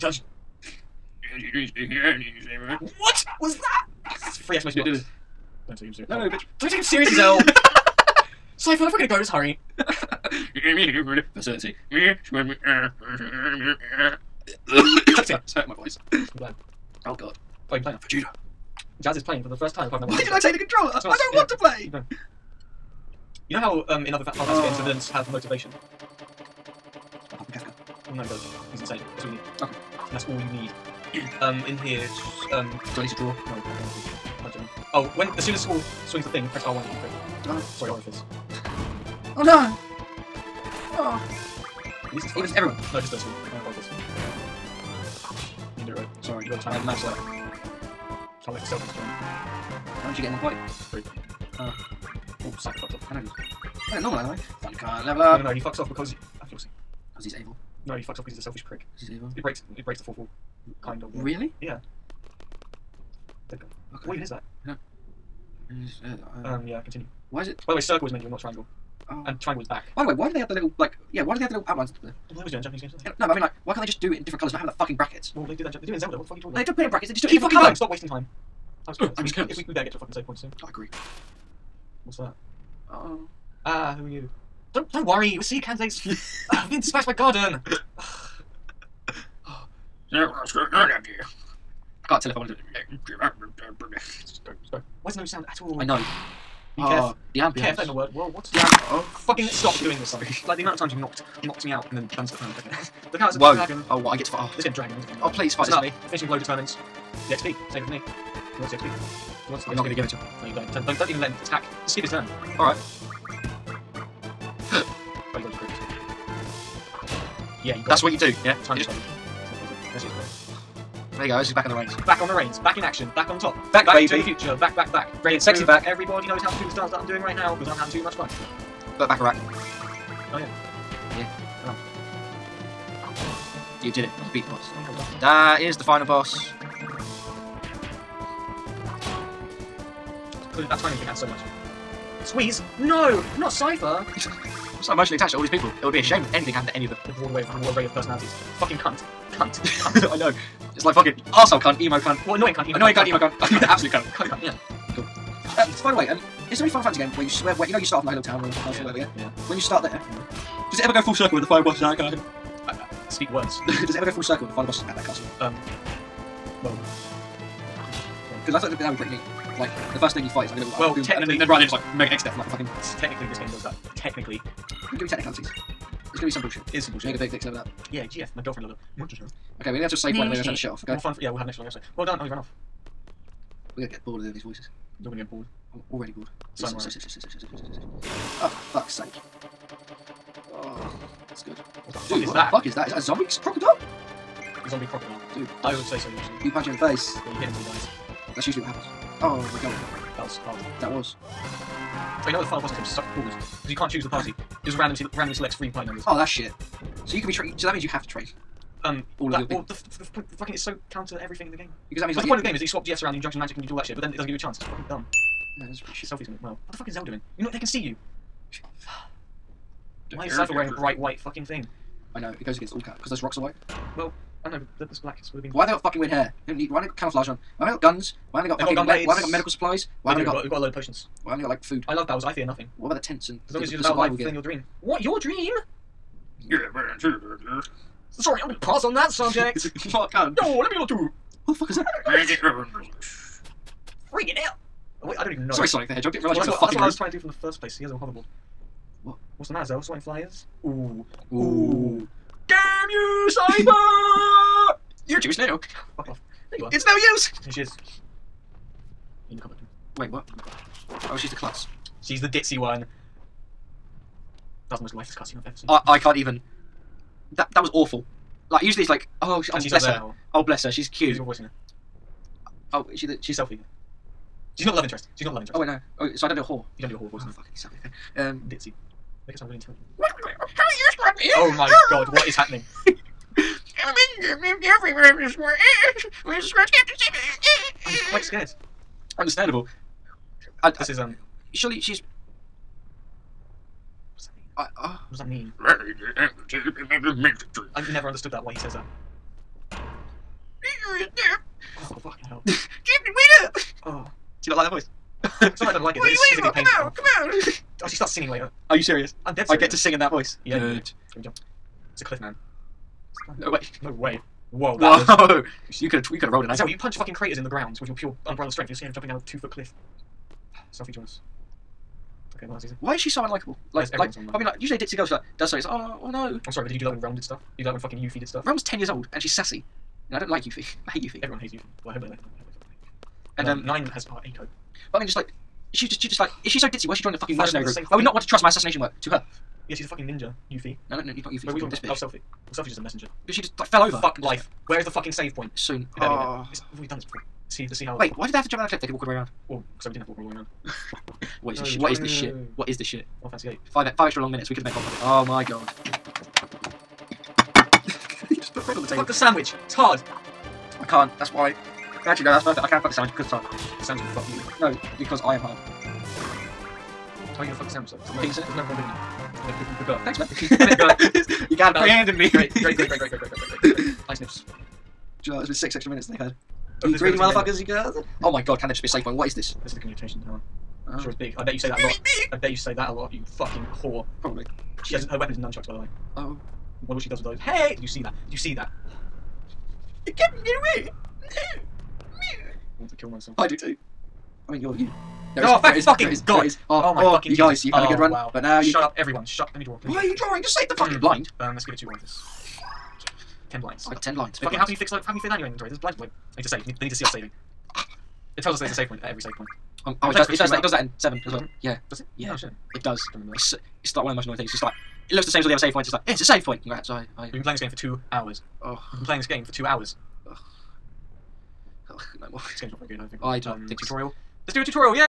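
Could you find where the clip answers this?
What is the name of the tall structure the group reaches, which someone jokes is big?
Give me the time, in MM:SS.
06:19.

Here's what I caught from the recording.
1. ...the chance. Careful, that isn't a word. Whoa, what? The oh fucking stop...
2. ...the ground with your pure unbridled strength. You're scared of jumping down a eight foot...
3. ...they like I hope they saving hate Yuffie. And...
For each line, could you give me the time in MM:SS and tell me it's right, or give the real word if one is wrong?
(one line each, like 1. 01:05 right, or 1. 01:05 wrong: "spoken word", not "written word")
1. 01:37 wrong: "ambience", not "chance"
2. 05:17 wrong: "two", not "eight"
3. 05:32 wrong: "fucking", not "saving".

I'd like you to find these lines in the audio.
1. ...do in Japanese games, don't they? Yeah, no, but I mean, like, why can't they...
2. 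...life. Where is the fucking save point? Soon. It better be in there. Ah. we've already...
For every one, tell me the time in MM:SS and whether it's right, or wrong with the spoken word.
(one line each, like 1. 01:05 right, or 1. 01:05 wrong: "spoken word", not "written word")
1. 01:12 right
2. 05:44 right.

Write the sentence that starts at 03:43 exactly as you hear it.
Well, I know, but the, this black would have been...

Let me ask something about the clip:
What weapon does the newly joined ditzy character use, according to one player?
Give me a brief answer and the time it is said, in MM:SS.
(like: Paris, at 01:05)
Nunchucks, at 06:25.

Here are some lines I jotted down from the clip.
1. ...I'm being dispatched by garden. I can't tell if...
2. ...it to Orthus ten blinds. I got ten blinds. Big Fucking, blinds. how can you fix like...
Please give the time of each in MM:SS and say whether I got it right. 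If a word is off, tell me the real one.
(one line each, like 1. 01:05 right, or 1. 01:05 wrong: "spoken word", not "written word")
1. 01:26 right
2. 06:41 right.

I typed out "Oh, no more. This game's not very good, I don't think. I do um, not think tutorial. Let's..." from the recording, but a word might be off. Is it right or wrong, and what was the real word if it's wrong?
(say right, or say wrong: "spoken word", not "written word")
right.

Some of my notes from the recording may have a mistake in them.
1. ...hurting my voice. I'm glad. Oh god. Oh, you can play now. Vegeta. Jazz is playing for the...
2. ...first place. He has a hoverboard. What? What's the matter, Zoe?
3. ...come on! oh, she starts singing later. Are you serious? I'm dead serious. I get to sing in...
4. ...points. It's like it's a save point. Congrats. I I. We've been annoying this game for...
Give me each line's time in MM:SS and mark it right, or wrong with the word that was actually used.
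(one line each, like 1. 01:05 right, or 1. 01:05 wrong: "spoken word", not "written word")
1. 00:15 right
2. 04:07 right
3. 05:07 right
4. 06:55 wrong: "playing", not "annoying".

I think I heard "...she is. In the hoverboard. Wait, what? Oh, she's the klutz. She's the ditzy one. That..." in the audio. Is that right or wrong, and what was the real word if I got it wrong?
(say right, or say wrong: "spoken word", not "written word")
wrong: "cupboard", not "hoverboard".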